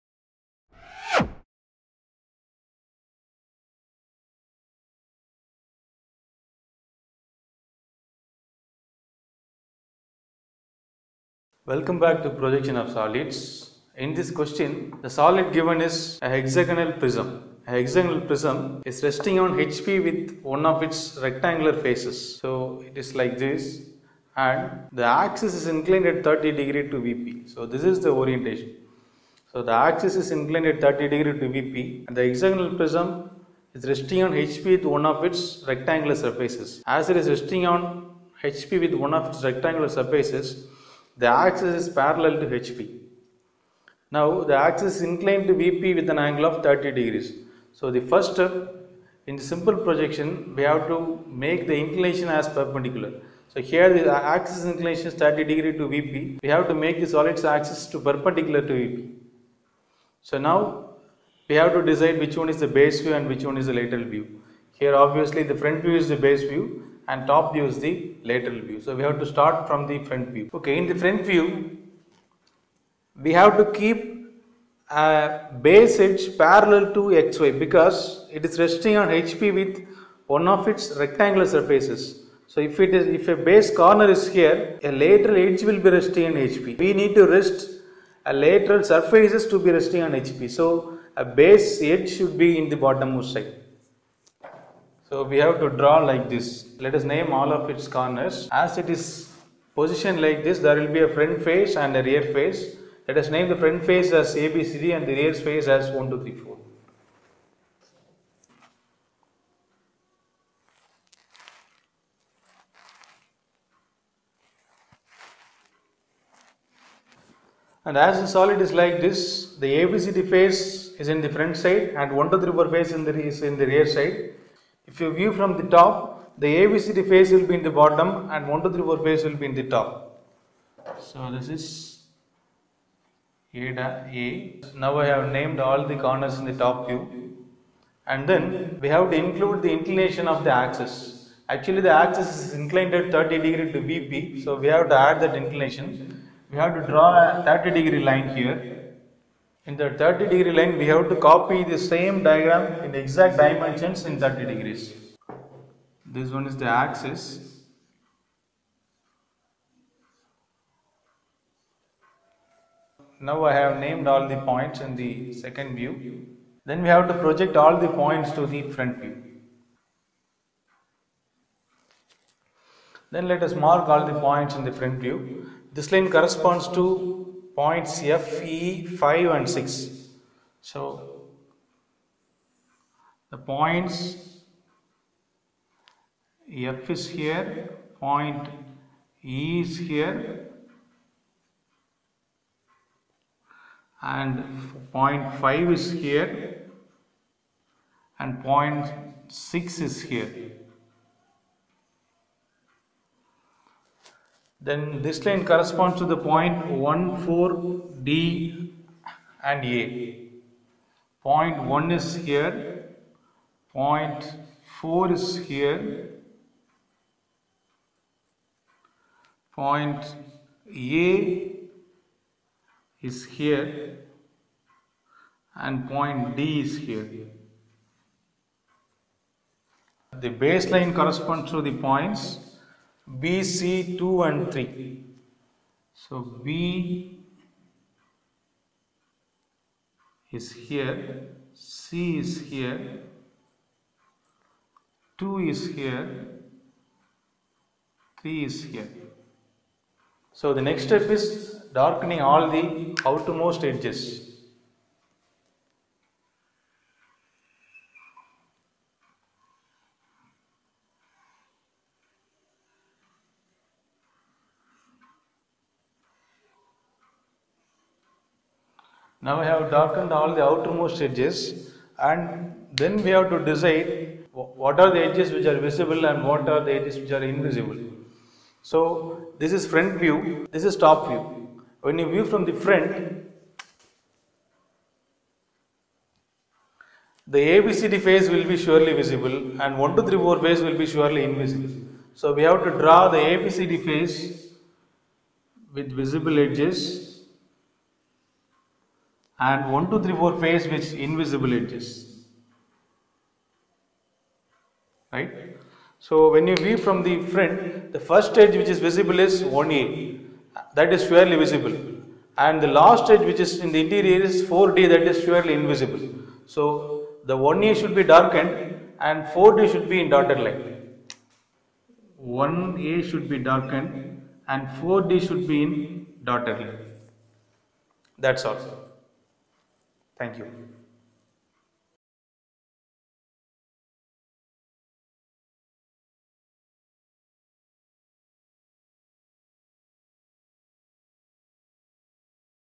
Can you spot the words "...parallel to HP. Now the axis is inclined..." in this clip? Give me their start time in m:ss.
0:41.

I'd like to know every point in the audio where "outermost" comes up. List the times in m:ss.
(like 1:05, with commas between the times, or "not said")
4:13, 4:30.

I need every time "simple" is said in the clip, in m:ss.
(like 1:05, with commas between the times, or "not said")
0:49.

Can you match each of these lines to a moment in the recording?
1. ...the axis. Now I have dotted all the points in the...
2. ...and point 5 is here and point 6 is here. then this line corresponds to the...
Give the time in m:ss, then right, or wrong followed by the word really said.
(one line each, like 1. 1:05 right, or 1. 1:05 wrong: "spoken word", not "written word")
1. 2:36 wrong: "named", not "dotted"
2. 3:14 right.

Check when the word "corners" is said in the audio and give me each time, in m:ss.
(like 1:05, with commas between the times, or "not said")
1:23, 1:37, 2:15.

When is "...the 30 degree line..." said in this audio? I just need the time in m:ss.
2:29.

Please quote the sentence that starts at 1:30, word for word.
So a base edge should be in the bottommost side.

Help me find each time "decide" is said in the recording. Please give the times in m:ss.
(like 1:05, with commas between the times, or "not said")
1:01, 4:33.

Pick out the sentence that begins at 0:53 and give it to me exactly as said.
So here the axis inclination is 30 degree to VP.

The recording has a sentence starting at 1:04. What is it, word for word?
Here obviously the front view is the base view and top view is the lateral view.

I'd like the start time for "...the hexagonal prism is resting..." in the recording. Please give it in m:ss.
0:32.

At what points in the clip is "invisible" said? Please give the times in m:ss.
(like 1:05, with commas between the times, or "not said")
4:37, 4:51, 5:01, 5:15.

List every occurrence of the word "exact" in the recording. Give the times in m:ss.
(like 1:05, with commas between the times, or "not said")
2:32.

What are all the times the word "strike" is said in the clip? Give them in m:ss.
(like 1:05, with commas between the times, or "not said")
not said.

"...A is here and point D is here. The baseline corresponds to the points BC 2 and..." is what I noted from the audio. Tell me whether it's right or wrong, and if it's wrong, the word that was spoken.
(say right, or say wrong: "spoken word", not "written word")
right.